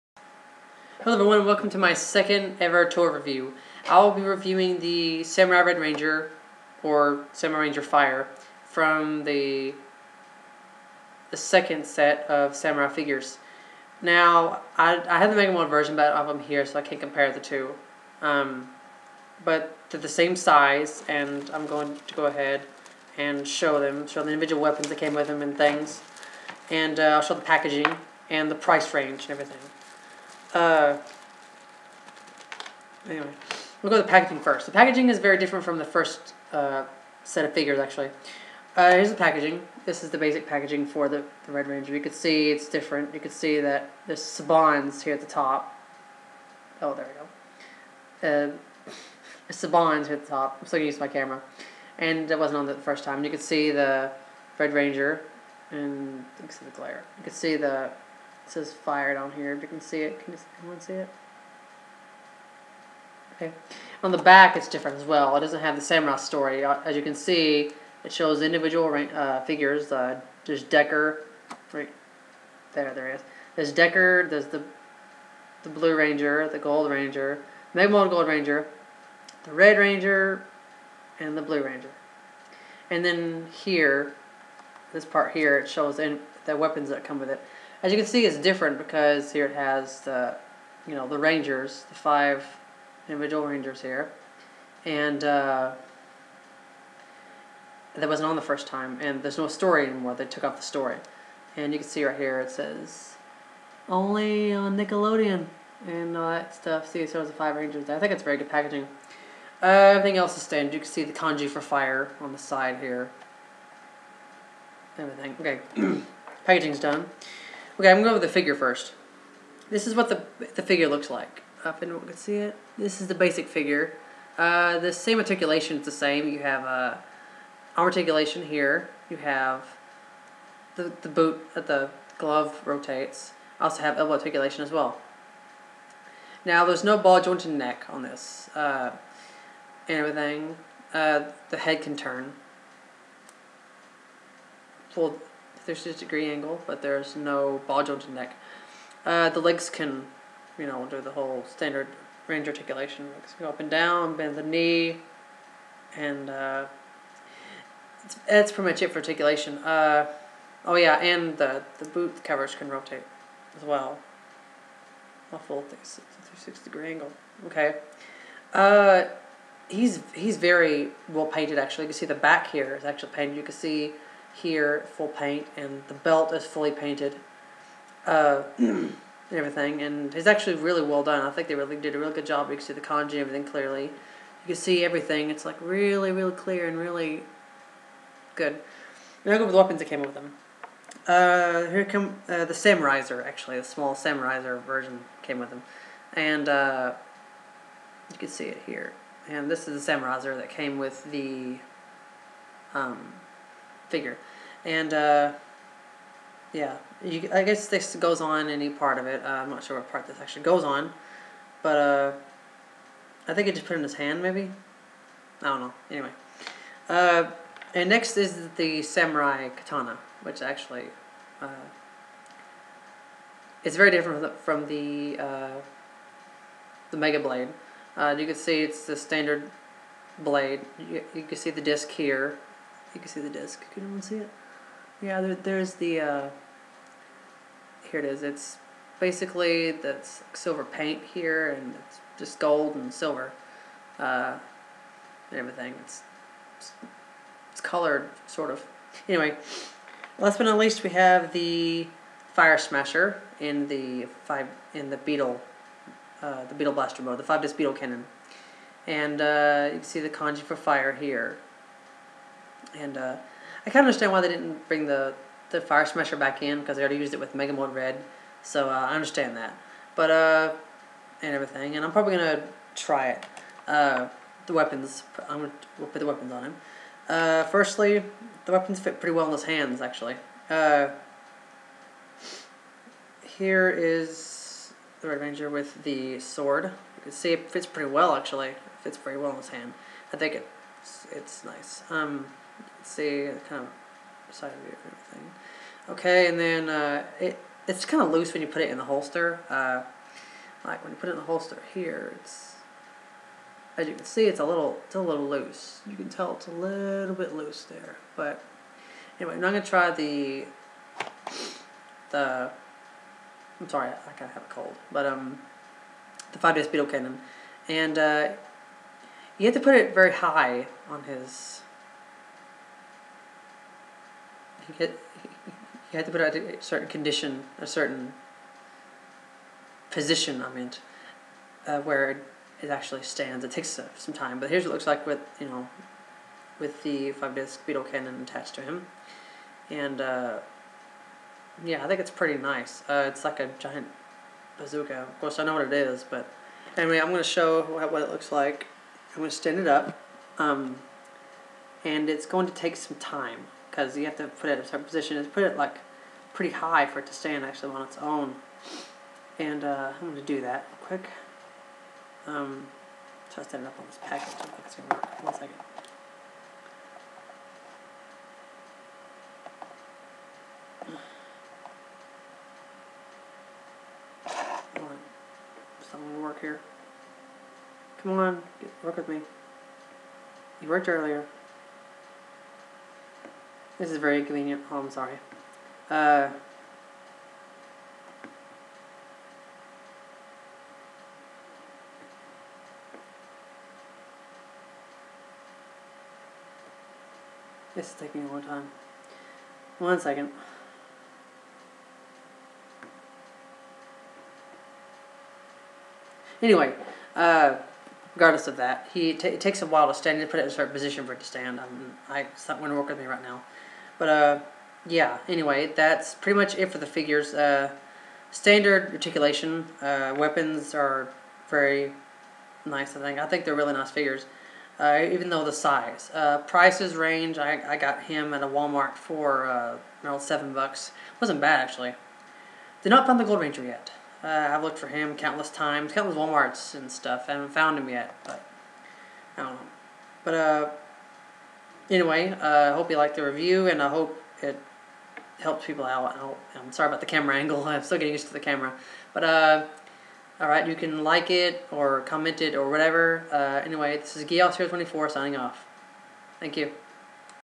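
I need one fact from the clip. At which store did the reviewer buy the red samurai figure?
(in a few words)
Walmart.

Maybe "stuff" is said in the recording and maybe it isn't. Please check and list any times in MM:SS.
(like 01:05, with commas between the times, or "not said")
01:46, 07:16.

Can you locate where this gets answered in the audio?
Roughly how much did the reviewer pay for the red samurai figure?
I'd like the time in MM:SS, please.
07:10.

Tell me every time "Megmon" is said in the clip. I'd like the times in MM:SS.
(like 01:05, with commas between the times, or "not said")
01:17.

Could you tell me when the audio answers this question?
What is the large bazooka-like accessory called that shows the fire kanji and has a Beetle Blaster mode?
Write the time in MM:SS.
04:17.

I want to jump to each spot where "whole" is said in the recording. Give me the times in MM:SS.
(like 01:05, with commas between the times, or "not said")
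02:31.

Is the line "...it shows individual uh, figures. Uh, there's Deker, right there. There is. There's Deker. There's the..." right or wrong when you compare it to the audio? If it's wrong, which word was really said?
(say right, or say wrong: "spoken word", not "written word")
right.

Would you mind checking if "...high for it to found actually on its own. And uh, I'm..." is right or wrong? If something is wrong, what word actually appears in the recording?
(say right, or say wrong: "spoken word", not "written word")
wrong: "stand", not "found".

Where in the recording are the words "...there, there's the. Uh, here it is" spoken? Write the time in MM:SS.
03:55.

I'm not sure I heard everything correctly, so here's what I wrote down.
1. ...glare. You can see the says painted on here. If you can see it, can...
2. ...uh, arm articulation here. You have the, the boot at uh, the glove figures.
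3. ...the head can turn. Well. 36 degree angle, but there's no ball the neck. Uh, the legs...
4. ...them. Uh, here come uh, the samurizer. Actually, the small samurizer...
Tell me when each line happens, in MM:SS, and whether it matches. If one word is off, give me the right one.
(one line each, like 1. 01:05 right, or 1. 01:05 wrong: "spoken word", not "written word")
1. 00:56 wrong: "fired", not "painted"
2. 02:06 wrong: "rotates", not "figures"
3. 02:21 right
4. 03:10 right.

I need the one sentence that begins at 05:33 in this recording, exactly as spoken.
It takes uh, some time, but here's what it looks like with, you know, with the 5-disc Beetle cannon attached to him.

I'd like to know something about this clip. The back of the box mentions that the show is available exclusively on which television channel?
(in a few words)
Nickelodeon.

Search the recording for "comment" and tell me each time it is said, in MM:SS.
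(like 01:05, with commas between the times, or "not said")
07:32.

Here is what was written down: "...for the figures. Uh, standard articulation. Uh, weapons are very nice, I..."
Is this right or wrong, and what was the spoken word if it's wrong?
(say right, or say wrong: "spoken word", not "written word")
right.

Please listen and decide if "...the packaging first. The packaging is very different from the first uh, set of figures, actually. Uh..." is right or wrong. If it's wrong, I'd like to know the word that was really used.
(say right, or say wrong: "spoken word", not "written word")
right.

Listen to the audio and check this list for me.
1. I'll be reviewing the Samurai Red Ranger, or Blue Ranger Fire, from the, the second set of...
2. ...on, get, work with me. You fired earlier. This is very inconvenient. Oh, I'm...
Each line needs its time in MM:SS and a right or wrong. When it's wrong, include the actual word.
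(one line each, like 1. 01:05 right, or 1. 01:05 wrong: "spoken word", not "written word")
1. 00:03 wrong: "Samurai", not "Blue"
2. 06:18 wrong: "worked", not "fired".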